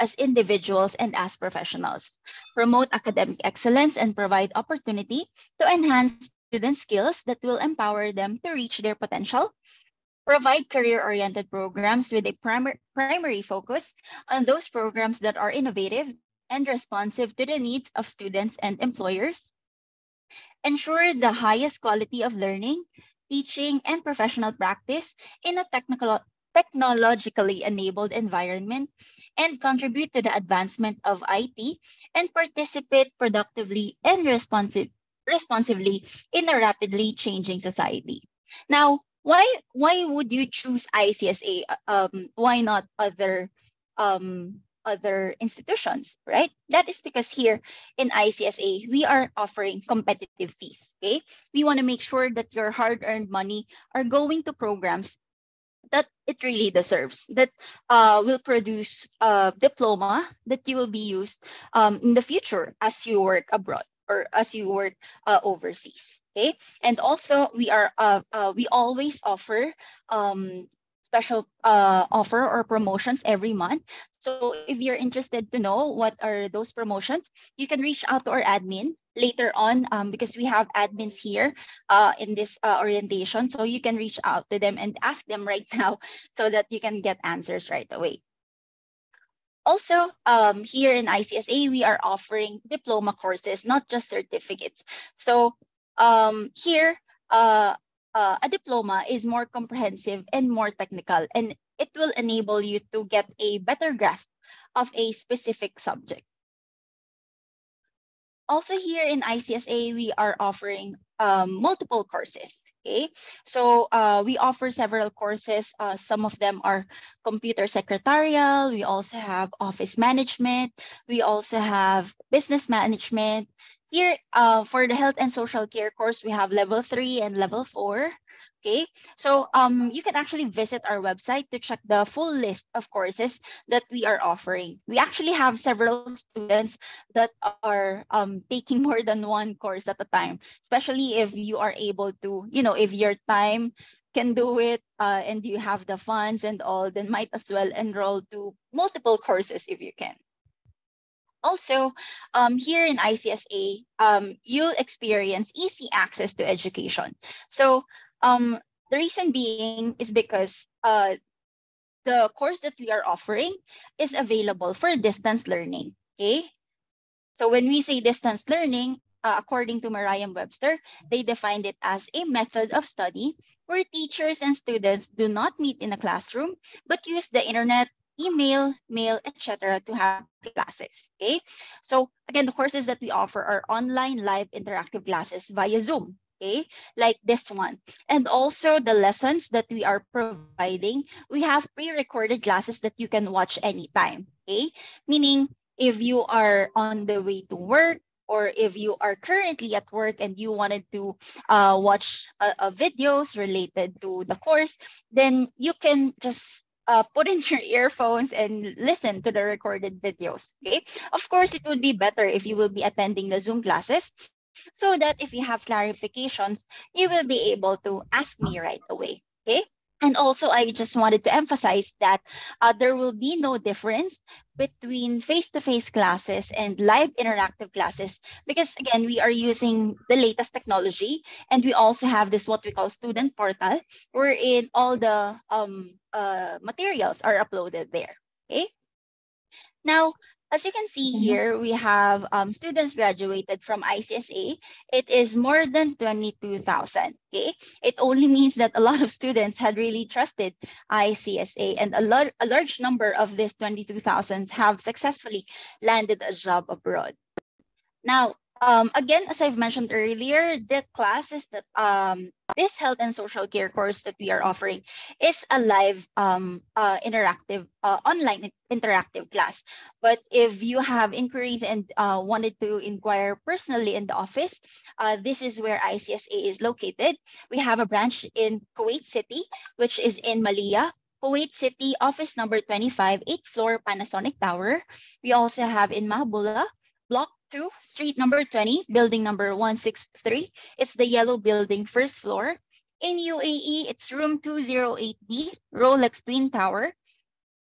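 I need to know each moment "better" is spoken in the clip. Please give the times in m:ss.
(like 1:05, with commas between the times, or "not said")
1:43, 3:31.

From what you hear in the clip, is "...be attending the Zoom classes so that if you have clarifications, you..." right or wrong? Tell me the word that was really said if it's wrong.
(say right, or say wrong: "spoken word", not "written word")
right.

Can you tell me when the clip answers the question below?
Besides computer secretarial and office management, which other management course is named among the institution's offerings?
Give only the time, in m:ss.
2:02.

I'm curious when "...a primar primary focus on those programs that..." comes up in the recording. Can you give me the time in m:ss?
0:12.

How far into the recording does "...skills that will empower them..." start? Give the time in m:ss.
0:06.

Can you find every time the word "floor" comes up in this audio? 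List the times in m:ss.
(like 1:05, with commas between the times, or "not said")
4:43, 4:52.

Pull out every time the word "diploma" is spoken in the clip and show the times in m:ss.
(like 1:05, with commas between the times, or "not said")
0:59, 1:32, 1:38.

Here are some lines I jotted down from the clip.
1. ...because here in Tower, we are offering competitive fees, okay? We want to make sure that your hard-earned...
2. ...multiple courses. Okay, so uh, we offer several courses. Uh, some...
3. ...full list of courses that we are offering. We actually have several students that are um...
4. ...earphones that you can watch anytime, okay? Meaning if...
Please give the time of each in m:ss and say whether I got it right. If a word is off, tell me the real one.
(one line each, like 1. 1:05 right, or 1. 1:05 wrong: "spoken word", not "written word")
1. 0:47 wrong: "ICSA", not "Tower"
2. 1:51 right
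3. 2:12 right
4. 3:12 wrong: "classes", not "earphones".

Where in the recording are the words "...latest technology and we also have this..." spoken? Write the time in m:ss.
3:50.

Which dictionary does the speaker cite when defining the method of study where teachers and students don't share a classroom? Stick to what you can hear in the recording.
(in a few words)
Merriam-Webster.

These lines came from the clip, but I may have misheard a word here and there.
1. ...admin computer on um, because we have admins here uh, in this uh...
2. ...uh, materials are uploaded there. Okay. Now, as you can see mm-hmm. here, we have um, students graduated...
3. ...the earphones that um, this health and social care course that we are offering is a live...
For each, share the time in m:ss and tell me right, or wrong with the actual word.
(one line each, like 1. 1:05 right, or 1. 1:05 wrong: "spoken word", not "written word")
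1. 1:18 wrong: "later", not "computer"
2. 3:56 right
3. 4:20 wrong: "classes", not "earphones".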